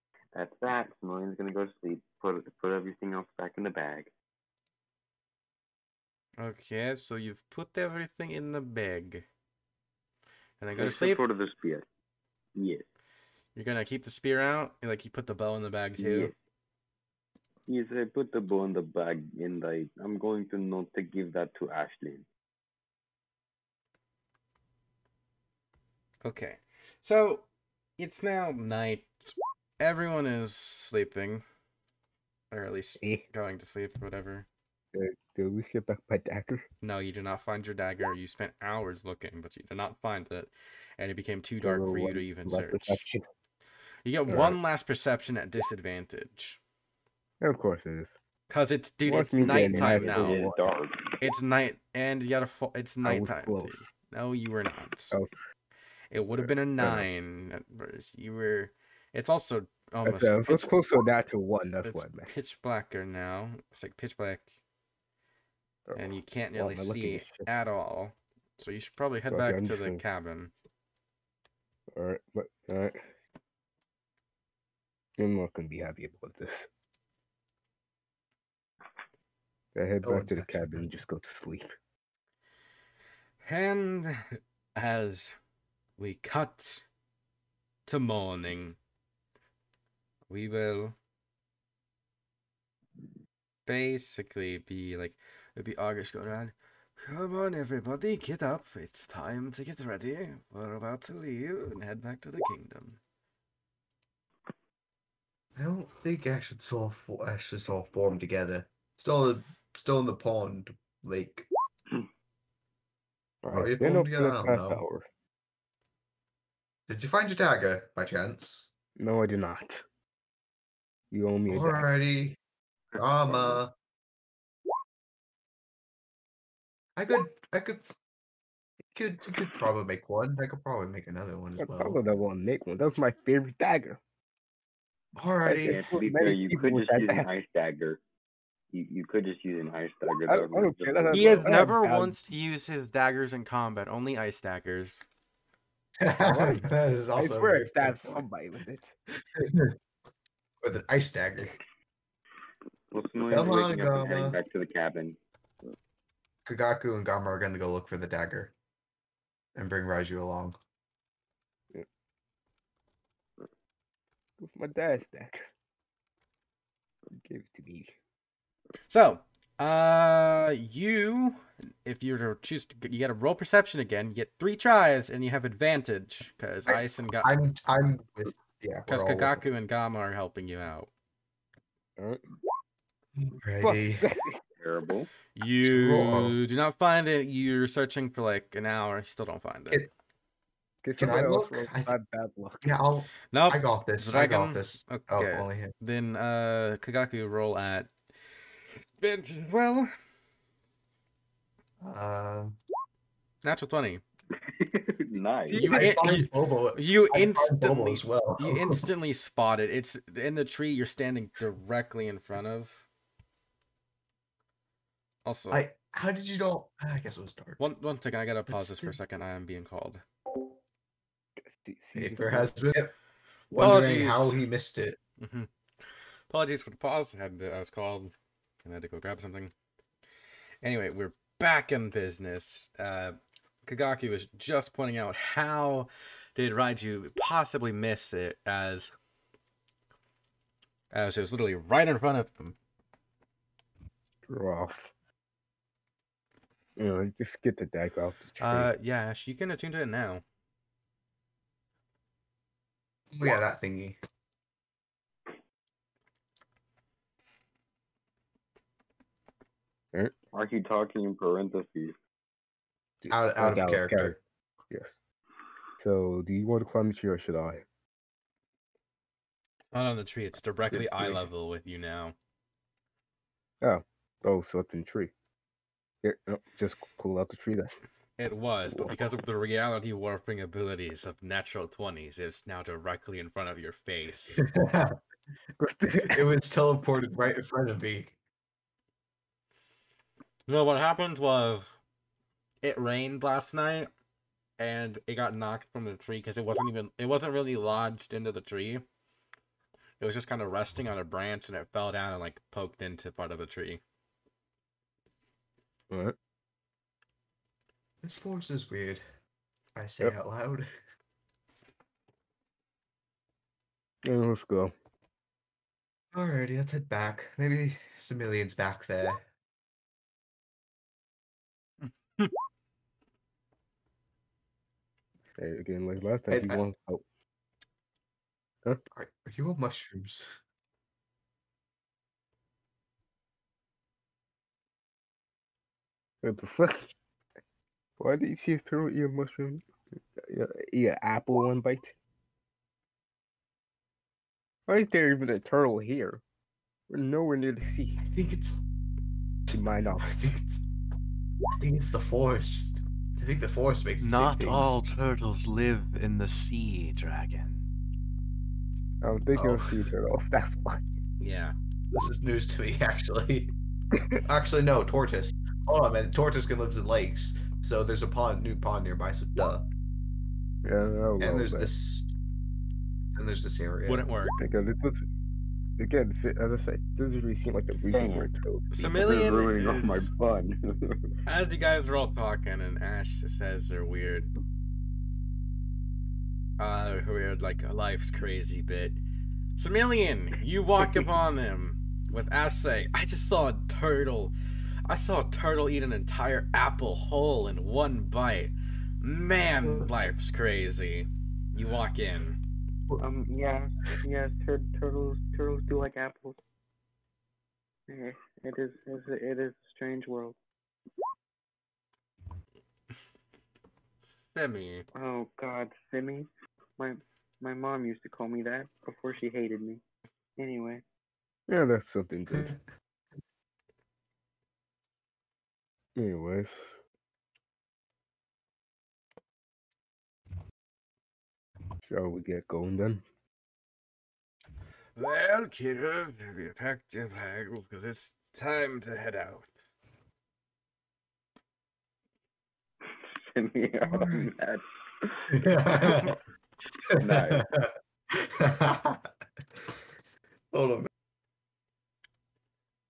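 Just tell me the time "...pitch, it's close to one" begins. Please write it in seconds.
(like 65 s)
60 s.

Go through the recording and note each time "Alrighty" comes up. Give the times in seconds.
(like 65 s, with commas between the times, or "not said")
121 s, 135 s, 316 s.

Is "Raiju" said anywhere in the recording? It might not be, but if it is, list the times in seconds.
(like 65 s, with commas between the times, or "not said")
159 s, 236 s.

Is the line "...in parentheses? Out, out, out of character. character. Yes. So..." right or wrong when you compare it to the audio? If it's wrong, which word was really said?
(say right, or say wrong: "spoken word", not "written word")
right.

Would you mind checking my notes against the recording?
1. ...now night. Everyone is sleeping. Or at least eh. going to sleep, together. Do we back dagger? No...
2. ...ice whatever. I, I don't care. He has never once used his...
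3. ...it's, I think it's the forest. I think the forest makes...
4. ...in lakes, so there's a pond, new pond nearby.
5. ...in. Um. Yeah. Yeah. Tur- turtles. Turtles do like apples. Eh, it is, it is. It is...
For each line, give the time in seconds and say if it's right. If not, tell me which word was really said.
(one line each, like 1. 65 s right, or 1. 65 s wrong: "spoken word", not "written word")
1. 28 s wrong: "whatever", not "together"
2. 139 s wrong: "dagger", not "whatever"
3. 350 s right
4. 366 s right
5. 401 s right.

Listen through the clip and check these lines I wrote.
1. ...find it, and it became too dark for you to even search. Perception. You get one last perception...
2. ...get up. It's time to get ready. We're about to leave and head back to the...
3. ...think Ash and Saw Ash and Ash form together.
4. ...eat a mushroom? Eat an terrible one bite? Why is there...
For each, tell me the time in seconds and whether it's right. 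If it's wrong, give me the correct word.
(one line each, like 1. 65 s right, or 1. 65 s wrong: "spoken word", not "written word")
1. 39 s right
2. 98 s right
3. 106 s wrong: "Saw", not "Ash"
4. 338 s wrong: "apple", not "terrible".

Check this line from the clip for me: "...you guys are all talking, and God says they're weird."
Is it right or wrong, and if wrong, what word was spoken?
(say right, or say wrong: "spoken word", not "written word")
wrong: "Ash", not "God".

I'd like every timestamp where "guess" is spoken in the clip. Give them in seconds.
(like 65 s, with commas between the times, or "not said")
216 s.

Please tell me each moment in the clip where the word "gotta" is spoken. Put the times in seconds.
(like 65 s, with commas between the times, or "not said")
52 s, 218 s.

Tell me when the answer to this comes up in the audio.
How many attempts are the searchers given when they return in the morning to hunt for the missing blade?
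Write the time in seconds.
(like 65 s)
174 s.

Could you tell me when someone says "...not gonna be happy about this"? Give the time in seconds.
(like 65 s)
75 s.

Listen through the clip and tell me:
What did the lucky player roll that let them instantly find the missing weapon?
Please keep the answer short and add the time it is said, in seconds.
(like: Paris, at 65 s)
Natural twenty, at 203 s.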